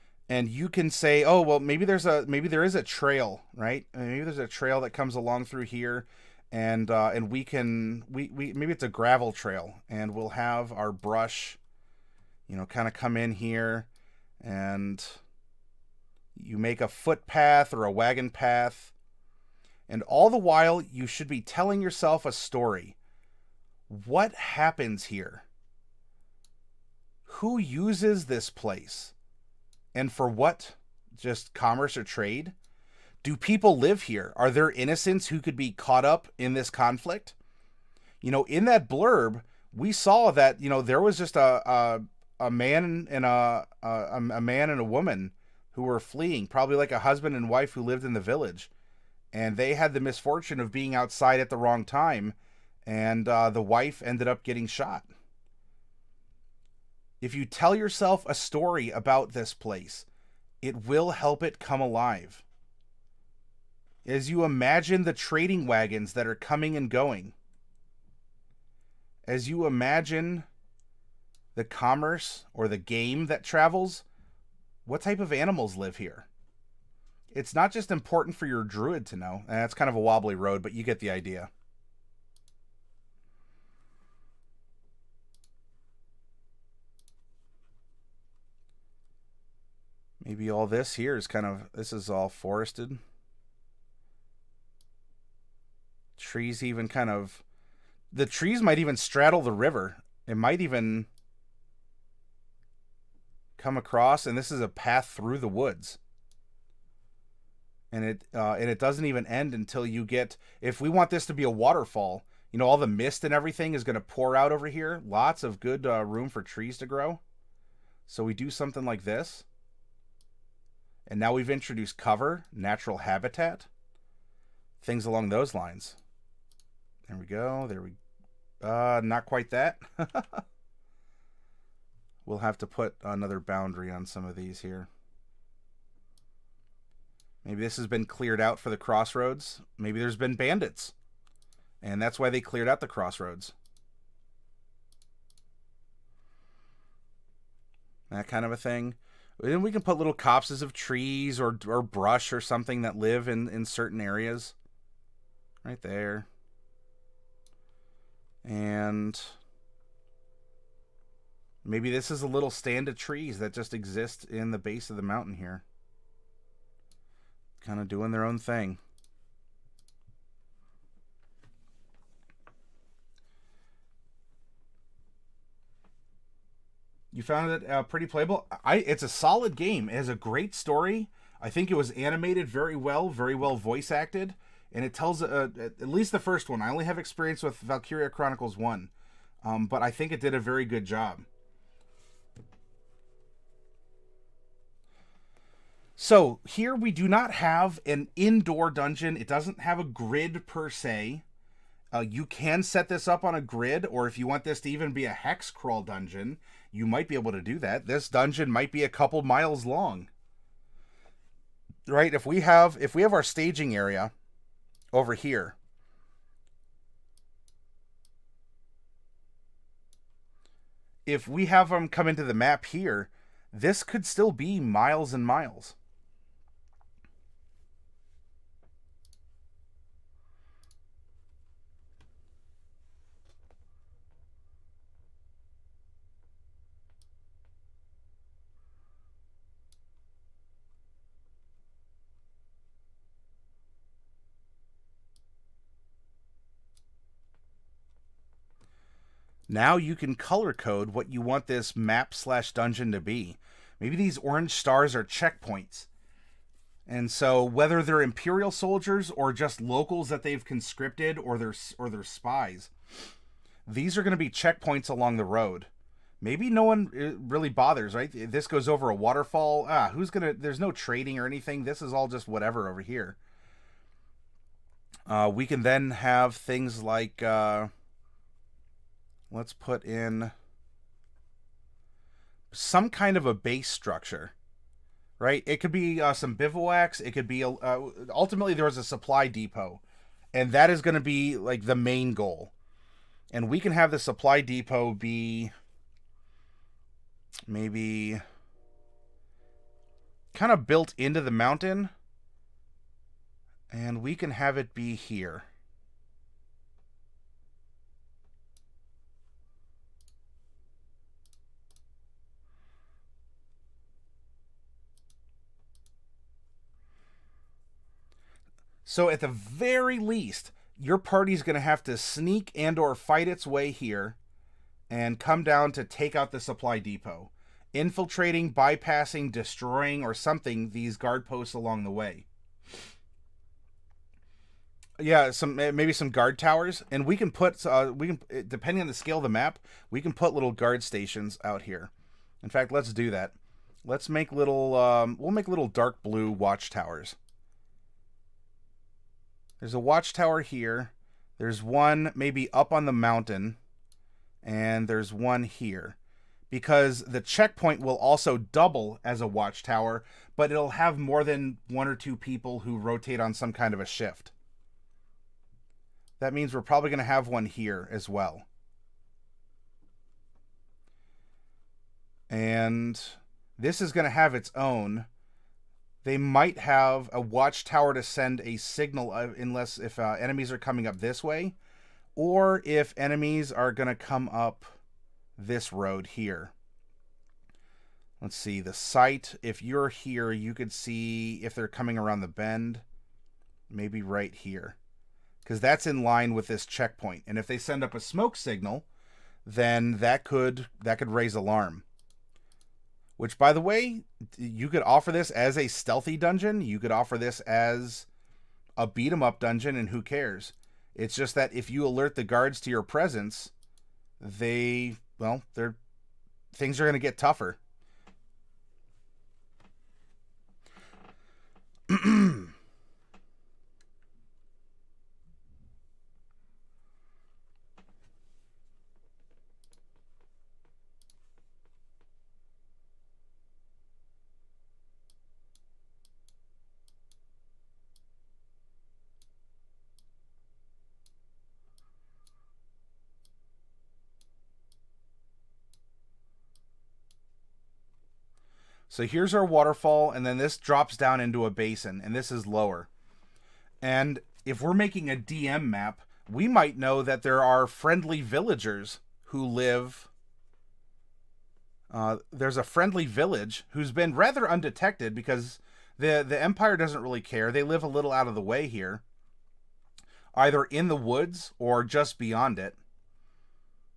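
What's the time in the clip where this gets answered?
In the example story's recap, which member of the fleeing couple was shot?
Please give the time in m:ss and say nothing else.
0:53.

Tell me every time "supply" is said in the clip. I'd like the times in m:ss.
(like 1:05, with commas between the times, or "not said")
4:48, 4:53, 5:26.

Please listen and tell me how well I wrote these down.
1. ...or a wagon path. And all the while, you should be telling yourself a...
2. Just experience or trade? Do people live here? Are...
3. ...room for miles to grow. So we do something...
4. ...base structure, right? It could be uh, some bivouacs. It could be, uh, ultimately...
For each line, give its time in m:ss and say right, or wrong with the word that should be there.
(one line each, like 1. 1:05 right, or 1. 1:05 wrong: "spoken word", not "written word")
1. 0:17 right
2. 0:31 wrong: "commerce", not "experience"
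3. 1:56 wrong: "trees", not "miles"
4. 4:43 right.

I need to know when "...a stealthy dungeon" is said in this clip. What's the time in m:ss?
6:45.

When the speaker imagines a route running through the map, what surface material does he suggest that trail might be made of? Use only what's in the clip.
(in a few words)
gravel.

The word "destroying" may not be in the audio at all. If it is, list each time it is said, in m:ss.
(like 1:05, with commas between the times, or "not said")
5:29.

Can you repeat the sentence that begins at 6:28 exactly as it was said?
Let's see, the site, if you're here, you could see if they're coming around the bend, maybe right here.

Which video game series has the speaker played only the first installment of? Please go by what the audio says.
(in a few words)
Valkyria Chronicles.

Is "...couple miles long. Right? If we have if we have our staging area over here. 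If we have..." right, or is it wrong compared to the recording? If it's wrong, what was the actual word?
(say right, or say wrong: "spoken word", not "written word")
right.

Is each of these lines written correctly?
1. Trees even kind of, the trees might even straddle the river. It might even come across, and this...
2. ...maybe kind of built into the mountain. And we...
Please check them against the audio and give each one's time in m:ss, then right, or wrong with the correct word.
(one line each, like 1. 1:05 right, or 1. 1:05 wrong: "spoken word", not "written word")
1. 1:36 right
2. 4:57 right.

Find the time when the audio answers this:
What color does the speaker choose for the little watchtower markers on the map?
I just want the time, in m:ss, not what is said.
5:45.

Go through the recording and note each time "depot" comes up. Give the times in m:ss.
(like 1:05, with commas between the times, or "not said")
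4:49, 4:54, 5:26.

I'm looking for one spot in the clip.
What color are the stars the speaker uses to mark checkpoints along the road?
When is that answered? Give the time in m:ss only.
4:14.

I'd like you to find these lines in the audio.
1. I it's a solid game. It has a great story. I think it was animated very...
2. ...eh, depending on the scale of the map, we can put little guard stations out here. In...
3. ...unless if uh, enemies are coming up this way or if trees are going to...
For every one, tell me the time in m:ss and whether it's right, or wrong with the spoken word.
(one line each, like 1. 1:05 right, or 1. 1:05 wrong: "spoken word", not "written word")
1. 2:58 right
2. 5:38 right
3. 6:19 wrong: "enemies", not "trees".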